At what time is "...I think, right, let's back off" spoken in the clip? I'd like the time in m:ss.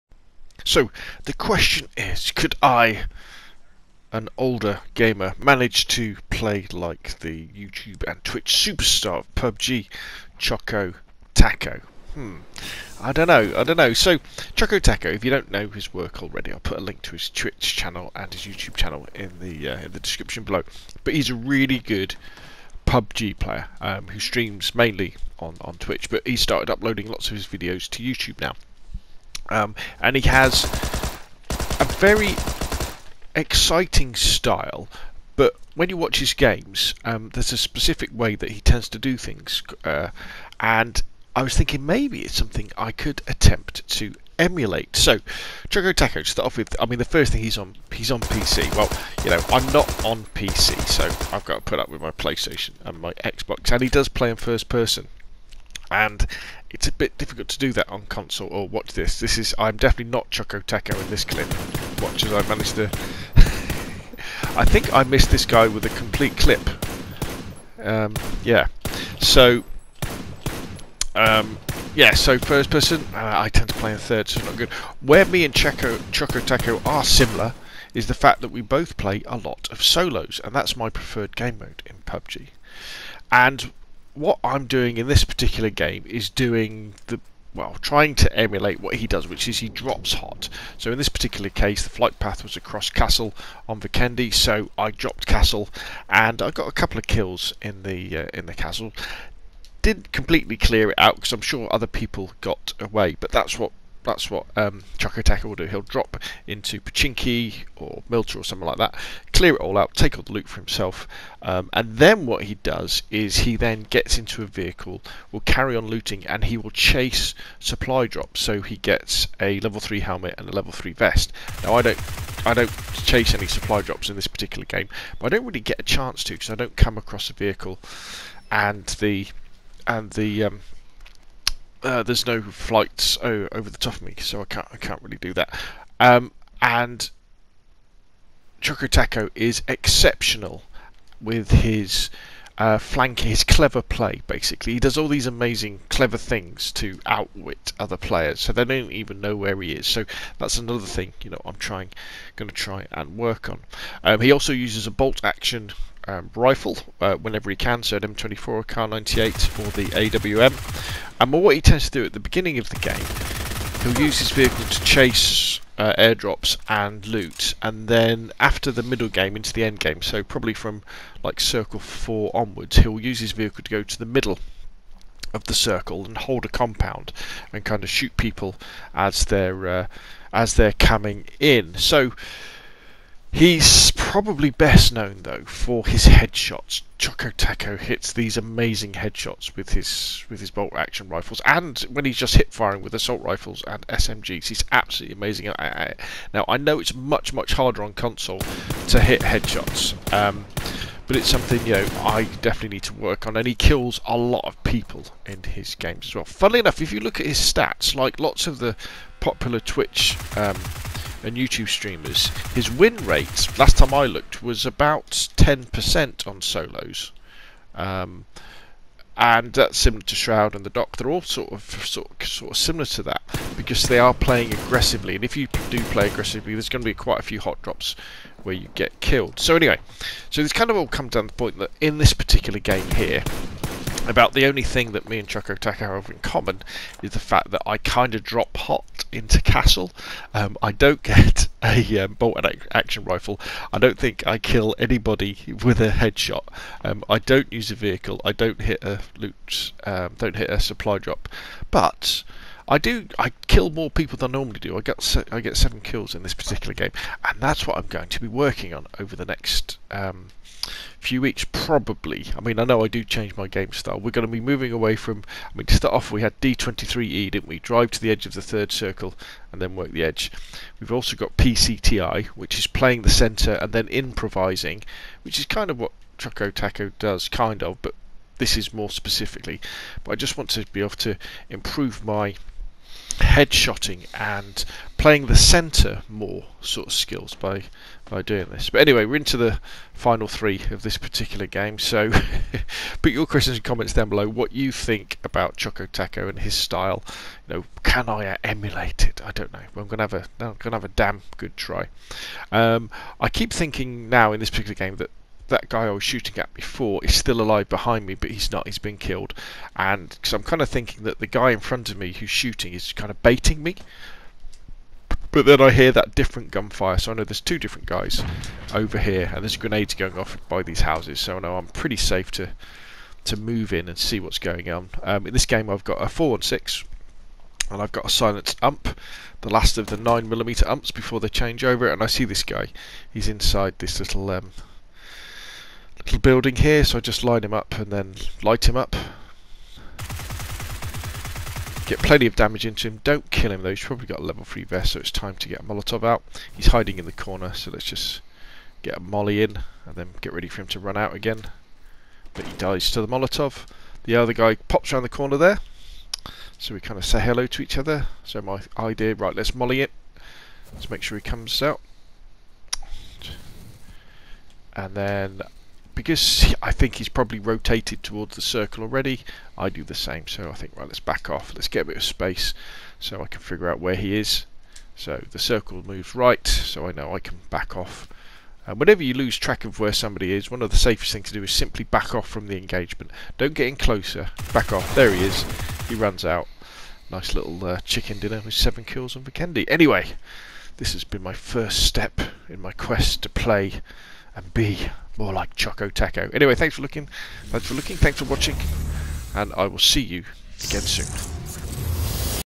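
6:10.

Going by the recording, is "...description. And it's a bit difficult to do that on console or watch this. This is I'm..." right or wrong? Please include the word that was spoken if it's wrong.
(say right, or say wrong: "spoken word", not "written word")
wrong: "person", not "description".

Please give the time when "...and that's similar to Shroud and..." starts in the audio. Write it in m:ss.
3:39.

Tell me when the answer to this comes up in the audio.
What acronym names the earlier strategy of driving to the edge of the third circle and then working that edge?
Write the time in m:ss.
4:26.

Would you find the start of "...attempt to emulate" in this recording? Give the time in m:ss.
0:43.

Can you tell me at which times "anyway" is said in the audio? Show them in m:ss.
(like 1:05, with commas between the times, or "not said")
3:49, 4:48, 6:29, 6:36.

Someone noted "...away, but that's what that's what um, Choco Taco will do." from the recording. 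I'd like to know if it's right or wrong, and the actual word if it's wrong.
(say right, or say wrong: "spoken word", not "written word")
right.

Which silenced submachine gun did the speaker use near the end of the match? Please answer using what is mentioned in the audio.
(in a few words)
UMP.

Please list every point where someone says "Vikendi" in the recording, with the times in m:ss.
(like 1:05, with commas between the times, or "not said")
1:33, 6:29.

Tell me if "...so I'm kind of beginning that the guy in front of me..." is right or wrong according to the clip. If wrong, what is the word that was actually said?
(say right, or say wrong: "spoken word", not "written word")
wrong: "thinking", not "beginning".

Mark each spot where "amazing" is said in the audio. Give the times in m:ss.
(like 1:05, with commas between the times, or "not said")
2:25, 3:08, 3:15.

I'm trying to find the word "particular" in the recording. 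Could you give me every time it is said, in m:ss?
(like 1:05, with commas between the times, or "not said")
1:25, 1:31, 2:04, 3:52, 4:16, 4:50, 5:04.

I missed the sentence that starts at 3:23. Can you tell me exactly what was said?
And he kills a lot of people in his games as well.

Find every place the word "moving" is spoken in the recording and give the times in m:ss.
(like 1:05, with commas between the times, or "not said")
4:24.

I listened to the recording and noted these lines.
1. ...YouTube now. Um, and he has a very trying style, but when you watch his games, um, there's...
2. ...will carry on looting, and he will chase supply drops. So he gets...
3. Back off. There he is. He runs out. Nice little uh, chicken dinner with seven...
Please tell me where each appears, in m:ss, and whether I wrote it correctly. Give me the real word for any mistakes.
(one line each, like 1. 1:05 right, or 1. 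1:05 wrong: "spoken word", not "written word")
1. 0:28 wrong: "exciting", not "trying"
2. 1:55 right
3. 6:24 right.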